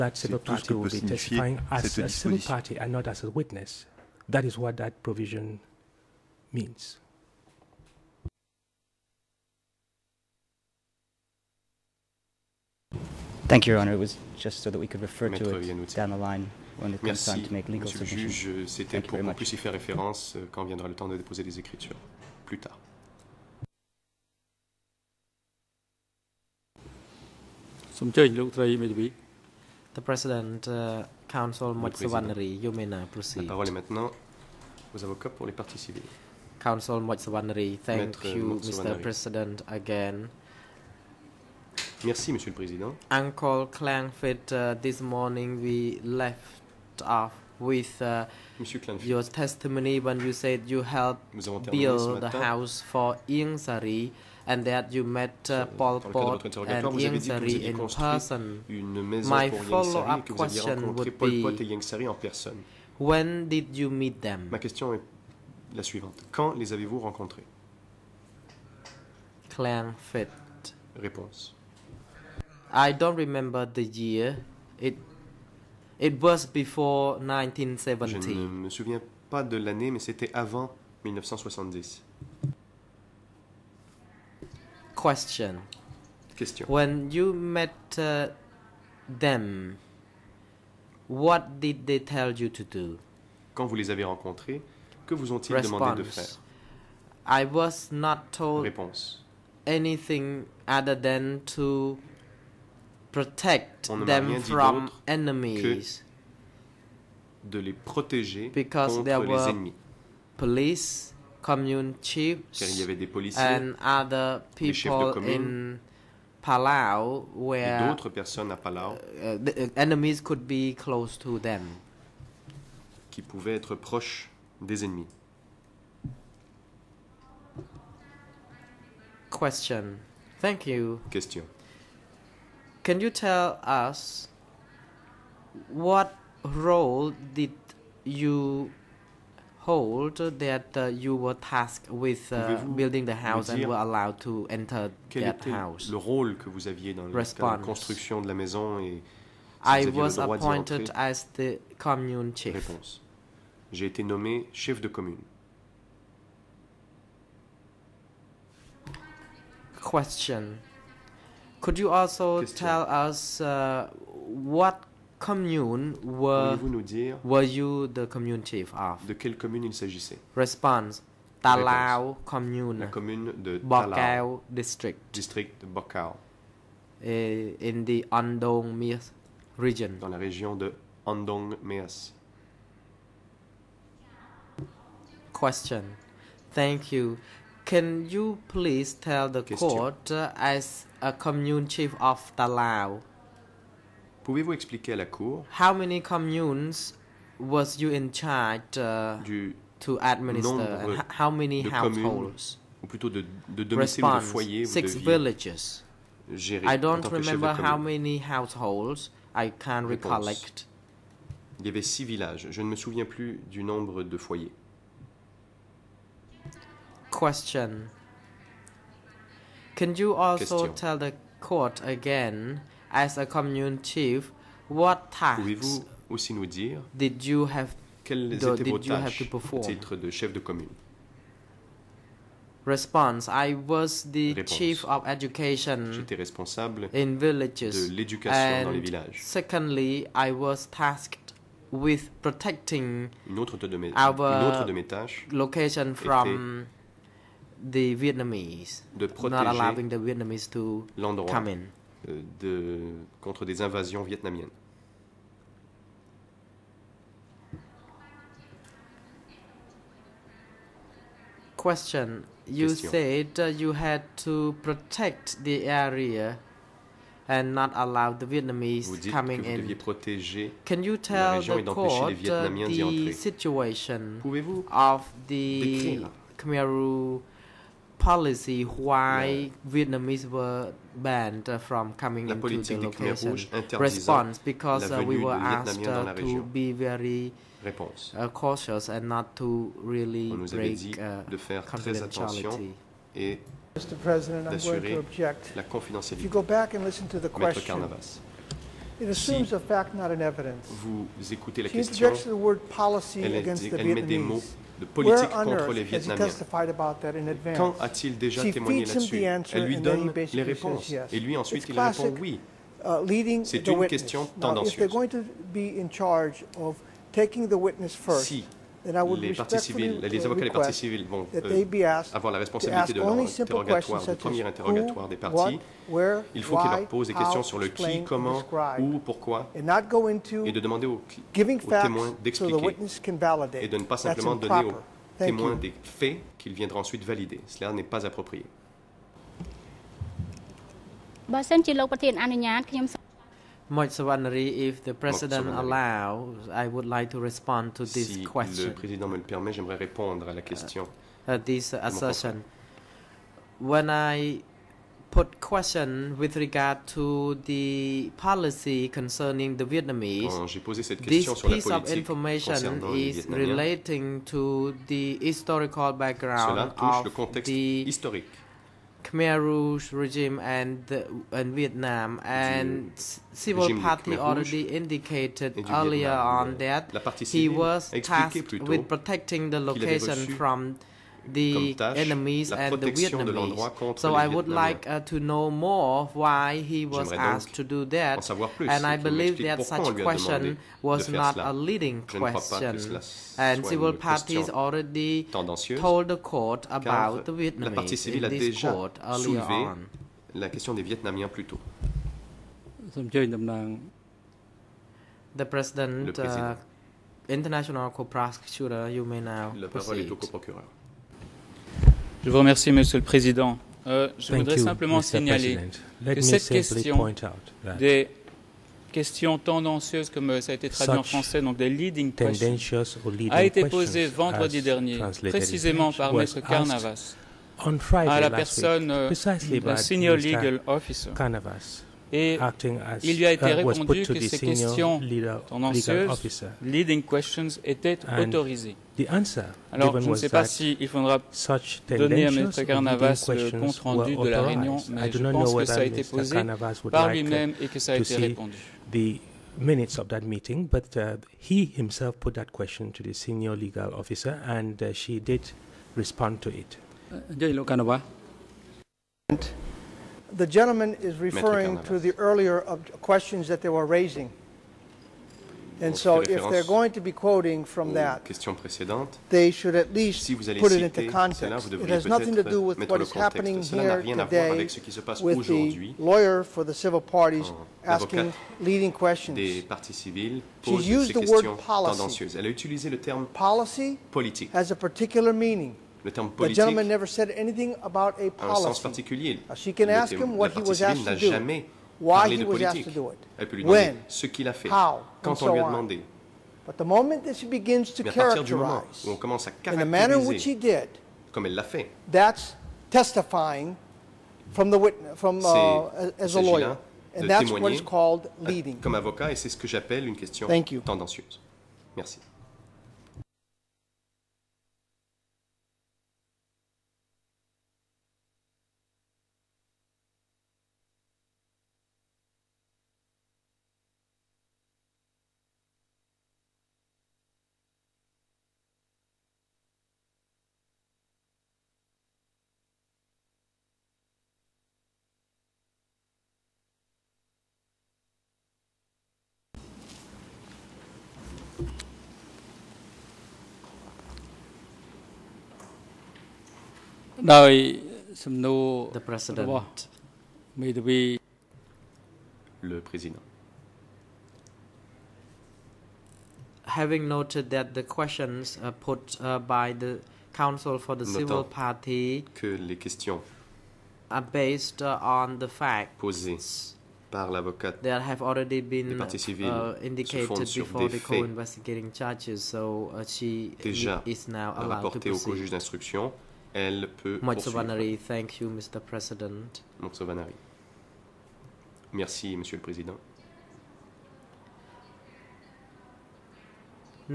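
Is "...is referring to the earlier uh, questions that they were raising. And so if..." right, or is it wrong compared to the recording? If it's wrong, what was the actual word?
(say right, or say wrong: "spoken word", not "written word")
right.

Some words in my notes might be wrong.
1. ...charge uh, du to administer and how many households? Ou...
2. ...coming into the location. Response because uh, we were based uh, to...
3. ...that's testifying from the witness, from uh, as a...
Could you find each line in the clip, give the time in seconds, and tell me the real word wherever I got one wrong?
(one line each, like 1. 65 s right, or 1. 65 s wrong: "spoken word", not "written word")
1. 198 s right
2. 281 s wrong: "asked", not "based"
3. 502 s right.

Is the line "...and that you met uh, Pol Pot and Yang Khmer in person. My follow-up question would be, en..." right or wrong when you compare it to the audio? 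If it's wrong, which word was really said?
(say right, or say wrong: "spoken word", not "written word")
wrong: "Sari", not "Khmer".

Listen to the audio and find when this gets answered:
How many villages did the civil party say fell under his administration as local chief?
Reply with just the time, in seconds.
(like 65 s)
211 s.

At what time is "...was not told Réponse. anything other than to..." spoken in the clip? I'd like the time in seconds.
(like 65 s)
97 s.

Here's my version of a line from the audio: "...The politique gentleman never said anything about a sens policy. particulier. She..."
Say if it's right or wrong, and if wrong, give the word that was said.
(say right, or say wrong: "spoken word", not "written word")
right.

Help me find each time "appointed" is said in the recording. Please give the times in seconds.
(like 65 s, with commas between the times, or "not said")
150 s.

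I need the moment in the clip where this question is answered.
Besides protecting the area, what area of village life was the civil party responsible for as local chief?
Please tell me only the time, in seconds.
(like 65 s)
234 s.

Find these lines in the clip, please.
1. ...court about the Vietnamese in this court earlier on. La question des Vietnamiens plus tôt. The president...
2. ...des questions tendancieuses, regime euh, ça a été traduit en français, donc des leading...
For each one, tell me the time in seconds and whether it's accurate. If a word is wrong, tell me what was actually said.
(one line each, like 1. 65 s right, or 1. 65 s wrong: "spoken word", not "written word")
1. 396 s right
2. 417 s wrong: "comme", not "regime".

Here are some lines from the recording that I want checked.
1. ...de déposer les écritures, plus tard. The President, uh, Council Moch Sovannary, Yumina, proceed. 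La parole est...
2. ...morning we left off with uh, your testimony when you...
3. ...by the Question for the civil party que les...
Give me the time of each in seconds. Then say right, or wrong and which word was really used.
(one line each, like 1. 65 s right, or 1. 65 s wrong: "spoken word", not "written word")
1. 21 s right
2. 45 s right
3. 559 s wrong: "Council", not "Question".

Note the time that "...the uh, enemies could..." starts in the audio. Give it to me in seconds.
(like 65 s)
119 s.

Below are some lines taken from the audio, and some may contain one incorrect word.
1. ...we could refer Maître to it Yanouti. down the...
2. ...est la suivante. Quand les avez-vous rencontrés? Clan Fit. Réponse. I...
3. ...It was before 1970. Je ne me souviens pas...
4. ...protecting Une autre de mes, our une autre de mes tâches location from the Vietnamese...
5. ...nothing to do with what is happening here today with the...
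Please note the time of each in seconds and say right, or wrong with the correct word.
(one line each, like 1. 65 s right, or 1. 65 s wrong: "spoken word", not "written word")
1. 14 s right
2. 64 s right
3. 75 s right
4. 242 s right
5. 472 s right.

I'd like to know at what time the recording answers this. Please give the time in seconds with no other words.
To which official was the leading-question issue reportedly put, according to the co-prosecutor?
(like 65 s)
429 s.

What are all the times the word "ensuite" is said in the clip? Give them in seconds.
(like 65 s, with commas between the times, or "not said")
311 s, 336 s.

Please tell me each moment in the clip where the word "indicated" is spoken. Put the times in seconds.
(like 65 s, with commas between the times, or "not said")
374 s, 569 s.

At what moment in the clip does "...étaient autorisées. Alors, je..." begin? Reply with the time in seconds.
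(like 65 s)
437 s.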